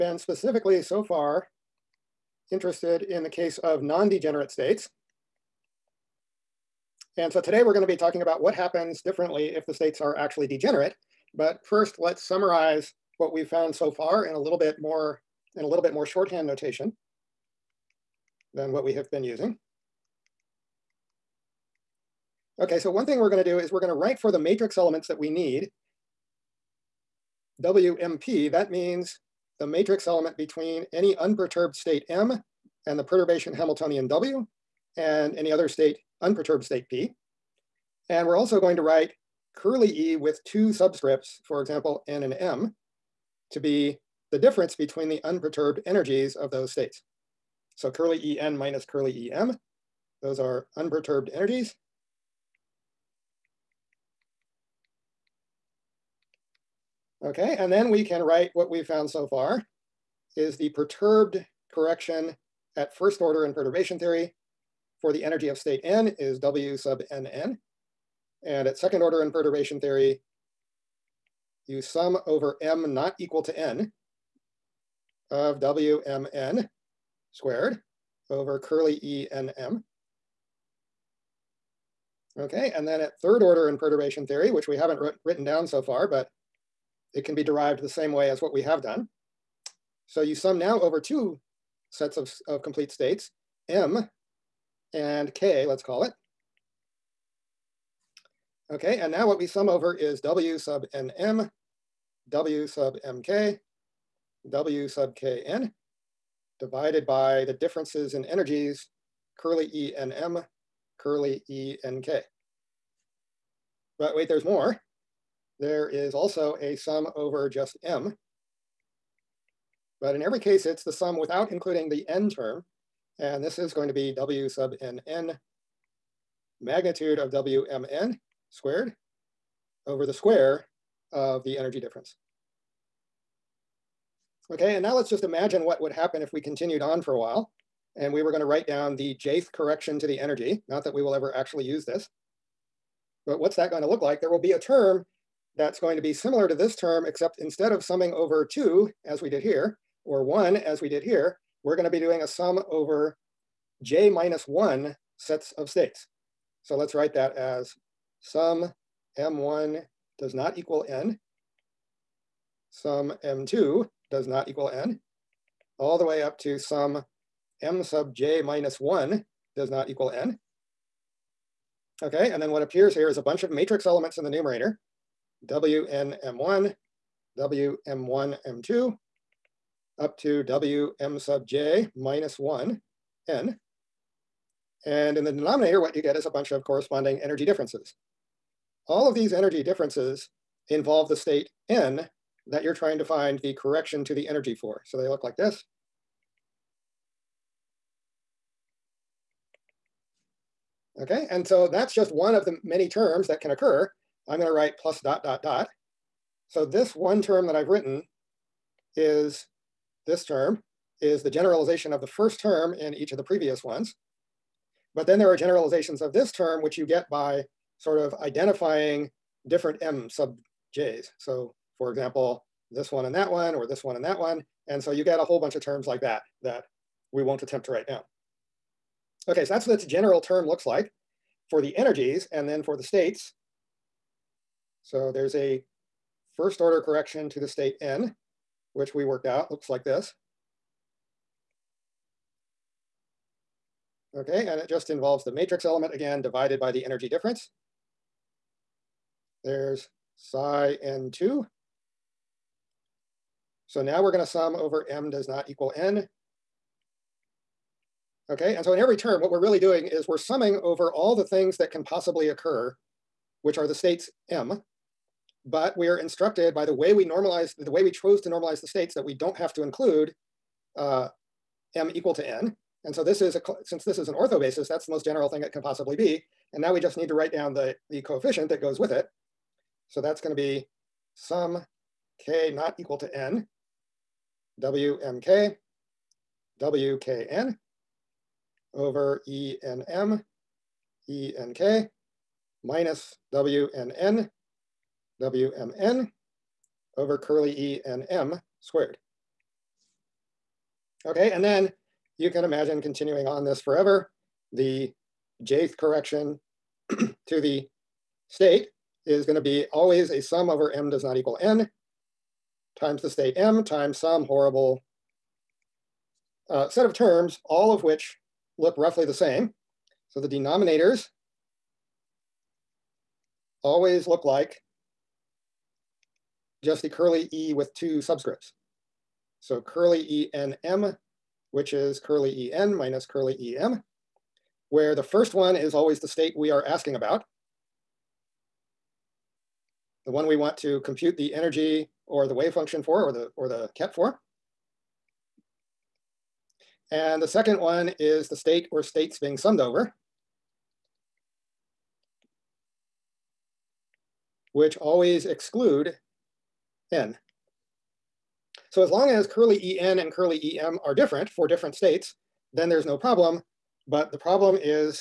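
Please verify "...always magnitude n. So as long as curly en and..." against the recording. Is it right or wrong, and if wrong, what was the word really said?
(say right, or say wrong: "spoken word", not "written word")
wrong: "exclude", not "magnitude".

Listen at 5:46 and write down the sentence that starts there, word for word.
And the second one is the state or states being summed over.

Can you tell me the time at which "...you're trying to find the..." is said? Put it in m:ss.
3:12.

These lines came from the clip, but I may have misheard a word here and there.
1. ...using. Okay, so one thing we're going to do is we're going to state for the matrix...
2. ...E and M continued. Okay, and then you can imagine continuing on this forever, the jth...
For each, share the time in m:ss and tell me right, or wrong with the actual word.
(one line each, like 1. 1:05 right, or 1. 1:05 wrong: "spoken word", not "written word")
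1. 0:19 wrong: "write", not "state"
2. 4:57 wrong: "squared", not "continued".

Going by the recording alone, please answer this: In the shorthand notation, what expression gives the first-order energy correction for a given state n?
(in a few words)
W sub nn.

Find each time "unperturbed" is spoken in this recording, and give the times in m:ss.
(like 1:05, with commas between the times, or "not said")
0:31, 0:36, 0:45, 0:50.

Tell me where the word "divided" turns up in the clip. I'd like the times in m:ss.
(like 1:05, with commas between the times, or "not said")
1:46, 4:06.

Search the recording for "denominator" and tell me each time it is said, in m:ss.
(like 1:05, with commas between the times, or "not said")
3:05, 5:20.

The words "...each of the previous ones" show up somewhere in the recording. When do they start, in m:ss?
3:32.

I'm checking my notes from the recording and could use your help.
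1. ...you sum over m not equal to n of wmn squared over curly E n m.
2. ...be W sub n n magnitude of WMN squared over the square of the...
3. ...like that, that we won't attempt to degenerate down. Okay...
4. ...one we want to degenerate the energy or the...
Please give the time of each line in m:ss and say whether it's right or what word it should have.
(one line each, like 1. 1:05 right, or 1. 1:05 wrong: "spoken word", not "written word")
1. 1:11 right
2. 2:03 right
3. 3:45 wrong: "write", not "degenerate"
4. 5:40 wrong: "compute", not "degenerate".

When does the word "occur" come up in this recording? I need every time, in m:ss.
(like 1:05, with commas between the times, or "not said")
3:23, 4:22.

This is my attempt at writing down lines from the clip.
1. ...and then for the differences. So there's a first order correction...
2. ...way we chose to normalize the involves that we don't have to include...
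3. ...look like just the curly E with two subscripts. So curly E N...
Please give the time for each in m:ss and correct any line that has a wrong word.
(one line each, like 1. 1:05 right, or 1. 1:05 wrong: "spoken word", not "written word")
1. 3:52 wrong: "states", not "differences"
2. 4:27 wrong: "states", not "involves"
3. 5:24 right.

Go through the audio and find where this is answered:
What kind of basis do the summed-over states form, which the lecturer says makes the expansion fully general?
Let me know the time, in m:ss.
4:34.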